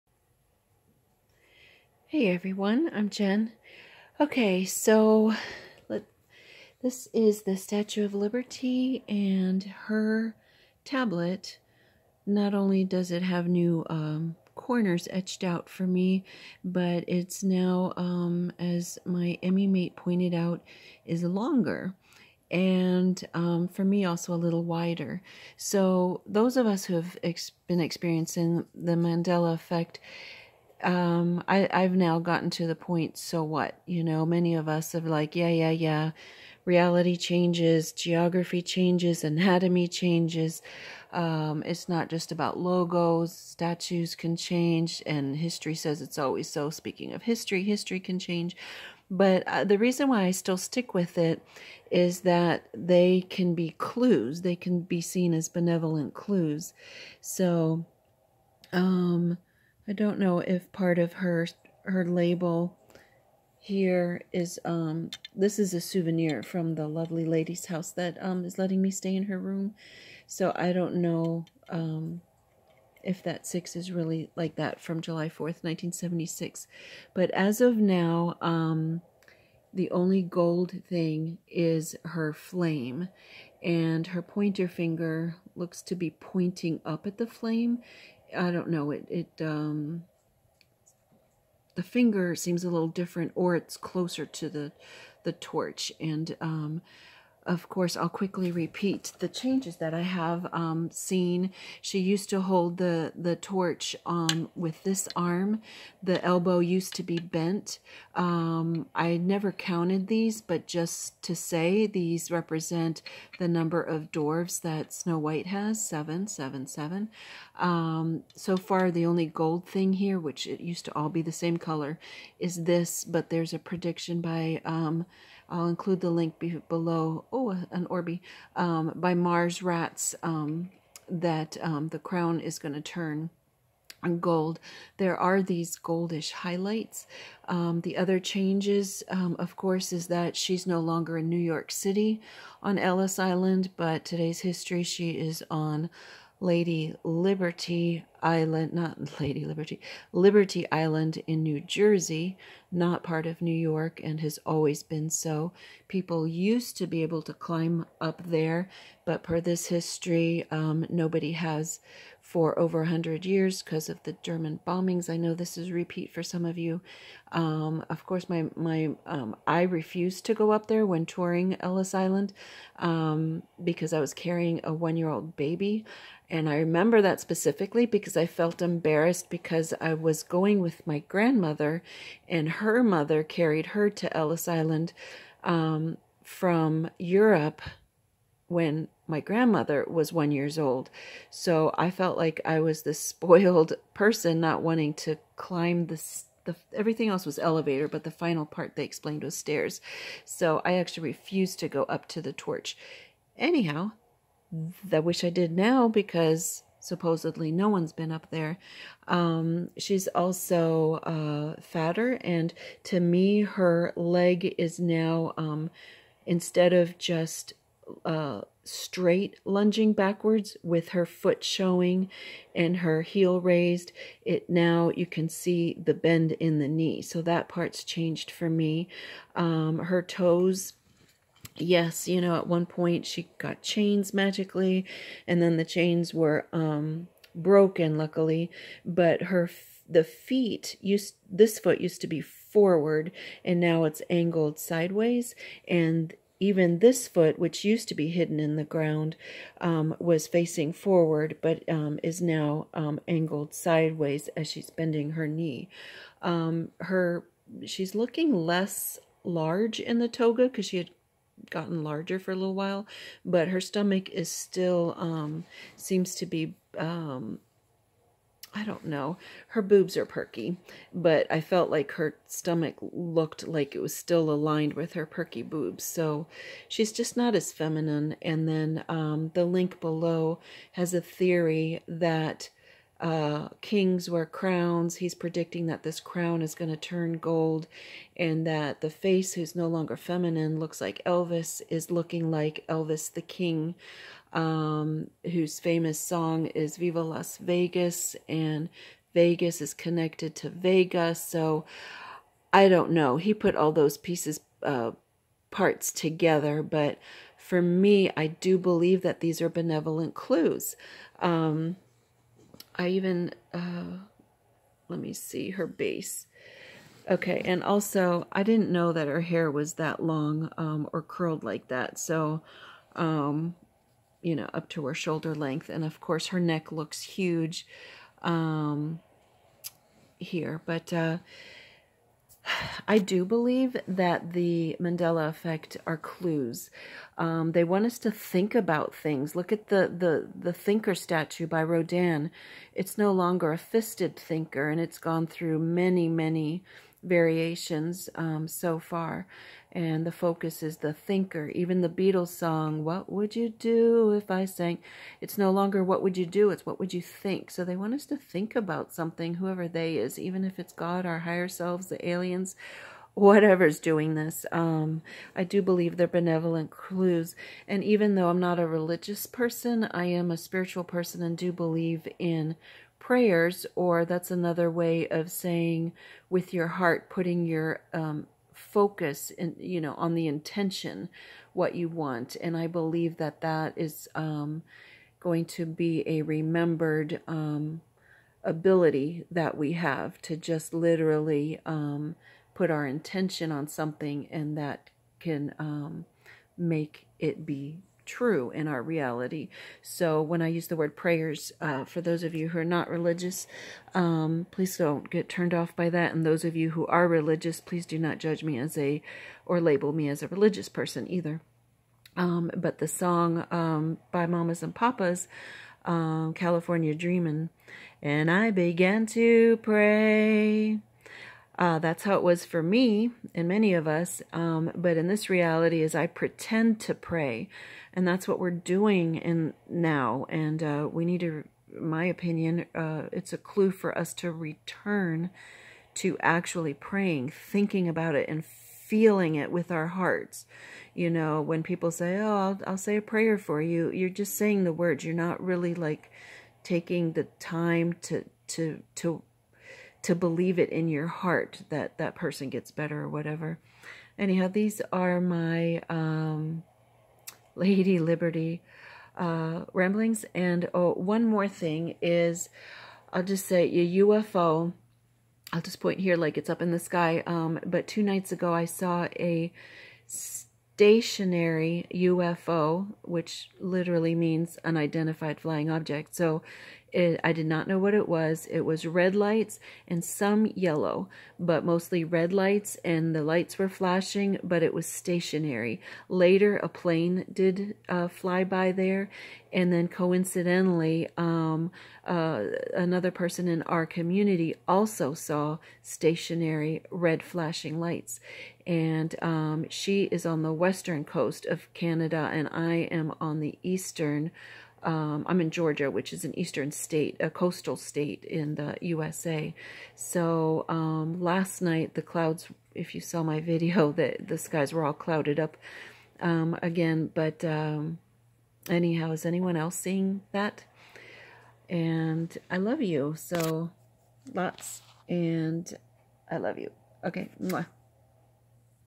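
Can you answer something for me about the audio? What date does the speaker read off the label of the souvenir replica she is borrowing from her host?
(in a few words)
July 4th, 1976.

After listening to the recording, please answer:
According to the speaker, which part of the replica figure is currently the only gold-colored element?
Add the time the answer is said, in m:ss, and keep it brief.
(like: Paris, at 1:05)
Her flame, at 1:22.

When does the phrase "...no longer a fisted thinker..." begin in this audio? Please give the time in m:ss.
5:42.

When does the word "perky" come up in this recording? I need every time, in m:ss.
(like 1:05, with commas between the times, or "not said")
4:30, 4:35.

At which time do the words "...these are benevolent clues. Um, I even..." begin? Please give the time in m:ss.
5:09.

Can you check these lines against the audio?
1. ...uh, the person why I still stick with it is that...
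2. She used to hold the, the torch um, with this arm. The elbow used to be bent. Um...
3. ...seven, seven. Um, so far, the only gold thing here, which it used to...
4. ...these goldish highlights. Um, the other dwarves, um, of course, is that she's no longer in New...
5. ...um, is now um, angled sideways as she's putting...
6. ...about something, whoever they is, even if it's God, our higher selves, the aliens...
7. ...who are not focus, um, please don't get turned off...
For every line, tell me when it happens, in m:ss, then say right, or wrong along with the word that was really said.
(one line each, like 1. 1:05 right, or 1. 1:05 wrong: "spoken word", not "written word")
1. 0:49 wrong: "reason", not "person"
2. 1:41 right
3. 1:56 right
4. 2:15 wrong: "changes", not "dwarves"
5. 4:11 wrong: "bending", not "putting"
6. 5:58 right
7. 6:42 wrong: "religious", not "focus".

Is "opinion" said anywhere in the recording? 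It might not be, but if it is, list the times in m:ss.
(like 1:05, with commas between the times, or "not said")
7:12.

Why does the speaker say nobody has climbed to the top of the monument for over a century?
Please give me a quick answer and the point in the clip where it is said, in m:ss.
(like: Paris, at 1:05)
German bombings, at 2:44.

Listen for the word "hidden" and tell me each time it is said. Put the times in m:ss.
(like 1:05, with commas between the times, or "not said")
4:08.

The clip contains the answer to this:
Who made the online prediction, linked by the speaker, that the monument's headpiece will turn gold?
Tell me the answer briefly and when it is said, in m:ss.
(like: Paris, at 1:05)
Mars Rats, at 2:09.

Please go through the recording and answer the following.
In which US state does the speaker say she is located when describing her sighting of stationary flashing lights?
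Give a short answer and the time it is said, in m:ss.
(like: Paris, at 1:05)
Georgia, at 8:25.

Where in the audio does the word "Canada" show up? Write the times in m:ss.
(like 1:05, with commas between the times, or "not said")
8:21.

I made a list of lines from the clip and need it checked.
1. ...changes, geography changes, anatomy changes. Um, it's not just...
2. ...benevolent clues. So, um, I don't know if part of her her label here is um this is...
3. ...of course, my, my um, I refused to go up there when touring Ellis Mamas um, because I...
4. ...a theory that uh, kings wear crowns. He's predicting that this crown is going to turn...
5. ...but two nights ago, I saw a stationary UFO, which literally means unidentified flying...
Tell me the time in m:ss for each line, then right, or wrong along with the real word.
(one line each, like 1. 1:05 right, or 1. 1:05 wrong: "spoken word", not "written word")
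1. 0:37 right
2. 0:55 right
3. 2:47 wrong: "Island", not "Mamas"
4. 4:40 right
5. 7:47 right.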